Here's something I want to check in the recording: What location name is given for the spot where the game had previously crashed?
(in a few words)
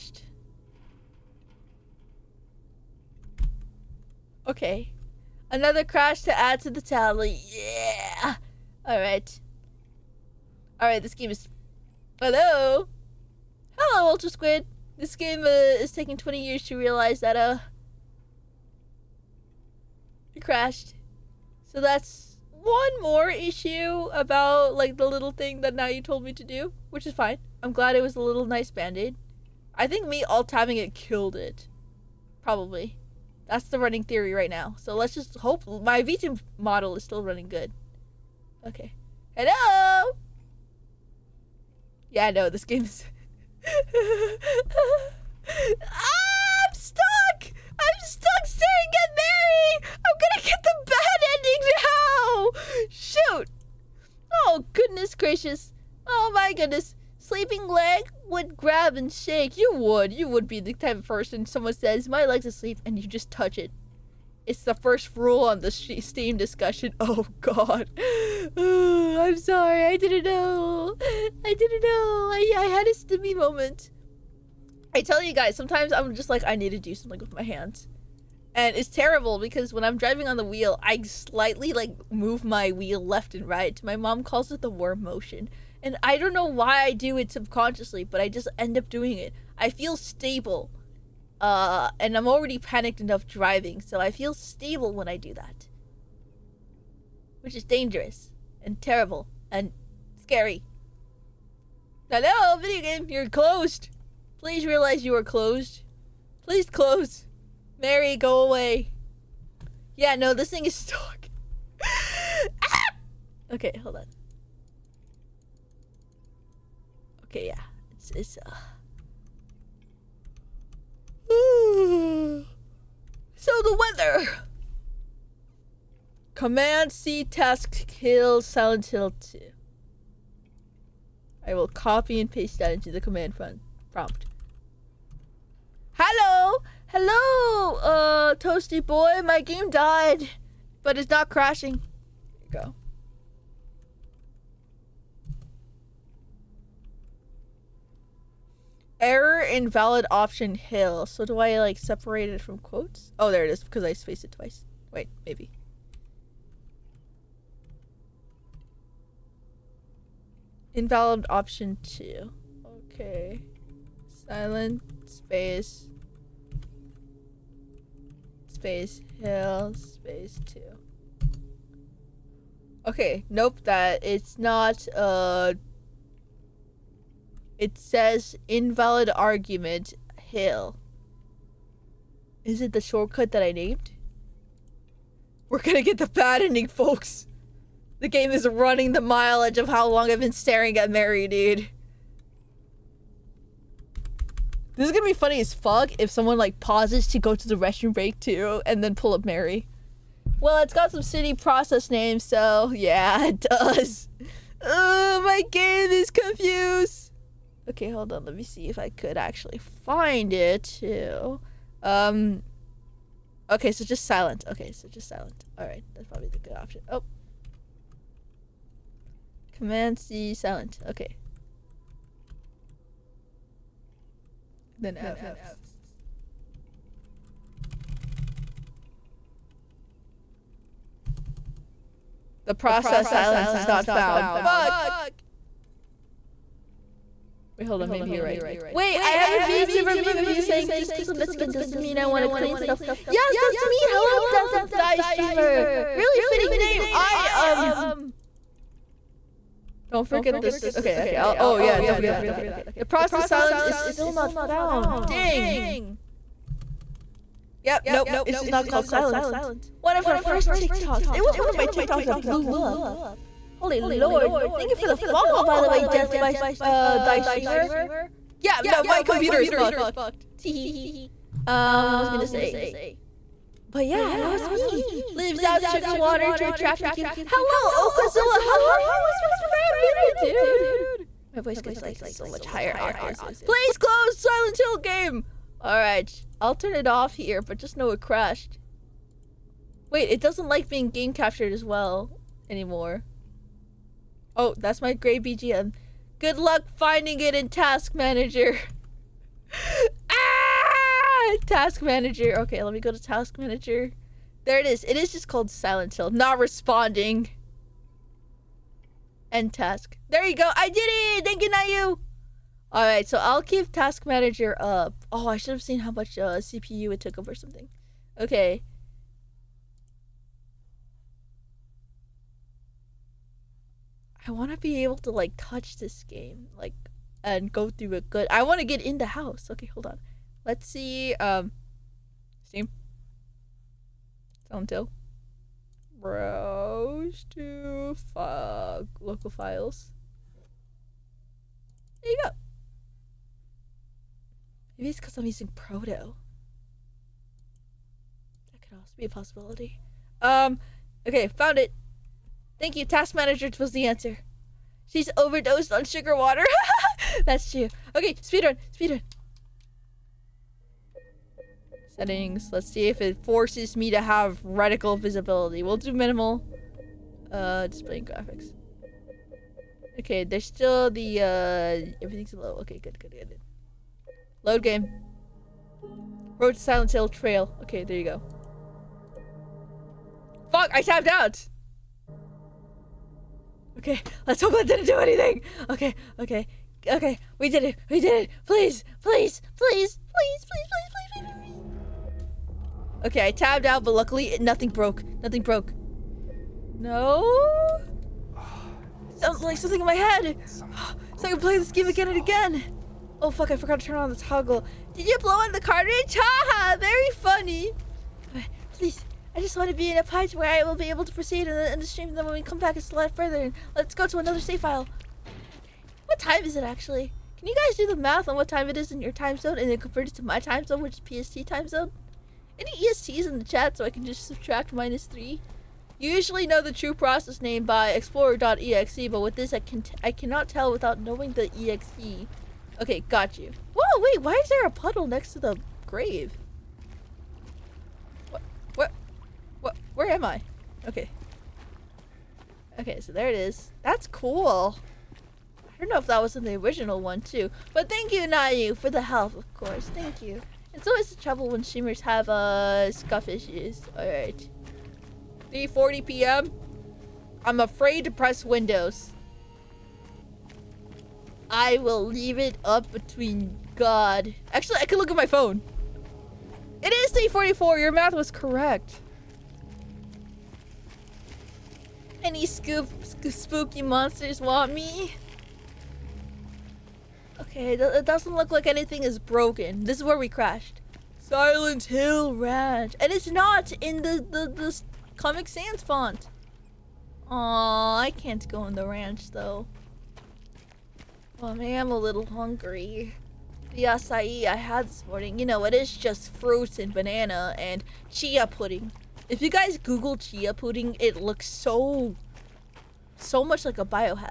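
Silent Hill Ranch.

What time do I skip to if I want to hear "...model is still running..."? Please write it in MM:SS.
00:36.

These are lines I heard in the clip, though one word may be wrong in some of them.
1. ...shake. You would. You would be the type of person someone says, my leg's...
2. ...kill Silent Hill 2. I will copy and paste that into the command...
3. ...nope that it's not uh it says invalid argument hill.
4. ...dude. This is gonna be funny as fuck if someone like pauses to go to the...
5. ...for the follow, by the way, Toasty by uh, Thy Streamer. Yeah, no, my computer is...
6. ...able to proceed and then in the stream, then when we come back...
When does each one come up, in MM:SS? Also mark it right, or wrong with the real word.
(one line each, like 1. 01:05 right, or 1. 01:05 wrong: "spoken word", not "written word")
1. 00:59 right
2. 02:07 right
3. 02:53 right
4. 03:11 right
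5. 04:24 wrong: "Death", not "Toasty"
6. 06:50 right.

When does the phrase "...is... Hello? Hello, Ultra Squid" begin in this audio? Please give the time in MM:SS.
00:11.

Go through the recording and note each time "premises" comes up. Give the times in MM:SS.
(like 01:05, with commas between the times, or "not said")
not said.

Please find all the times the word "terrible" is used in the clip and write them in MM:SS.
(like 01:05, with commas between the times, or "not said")
01:18, 01:38.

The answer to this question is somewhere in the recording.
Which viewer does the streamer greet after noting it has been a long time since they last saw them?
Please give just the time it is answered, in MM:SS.
04:37.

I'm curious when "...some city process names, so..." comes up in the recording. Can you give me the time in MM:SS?
03:20.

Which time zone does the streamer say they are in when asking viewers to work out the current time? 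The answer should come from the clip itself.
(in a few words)
PST.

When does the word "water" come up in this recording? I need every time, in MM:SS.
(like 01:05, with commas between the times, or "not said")
04:35, 05:56.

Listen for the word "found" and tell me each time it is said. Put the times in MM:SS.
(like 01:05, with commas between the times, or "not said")
03:53, 04:14, 05:51.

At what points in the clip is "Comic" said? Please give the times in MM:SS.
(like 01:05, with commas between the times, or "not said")
08:05.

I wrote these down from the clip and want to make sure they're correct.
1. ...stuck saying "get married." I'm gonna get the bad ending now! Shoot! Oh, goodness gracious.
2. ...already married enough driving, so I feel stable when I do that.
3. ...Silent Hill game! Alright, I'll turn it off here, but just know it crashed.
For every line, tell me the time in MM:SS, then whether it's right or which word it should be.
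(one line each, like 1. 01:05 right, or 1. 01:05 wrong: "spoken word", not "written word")
1. 00:48 right
2. 01:32 wrong: "panicked", not "married"
3. 04:44 right.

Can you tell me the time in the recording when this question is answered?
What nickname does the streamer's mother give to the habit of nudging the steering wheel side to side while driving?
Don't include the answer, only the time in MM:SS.
01:24.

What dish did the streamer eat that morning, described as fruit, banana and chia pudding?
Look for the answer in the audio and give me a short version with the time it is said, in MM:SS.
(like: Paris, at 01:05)
acai, at 08:13.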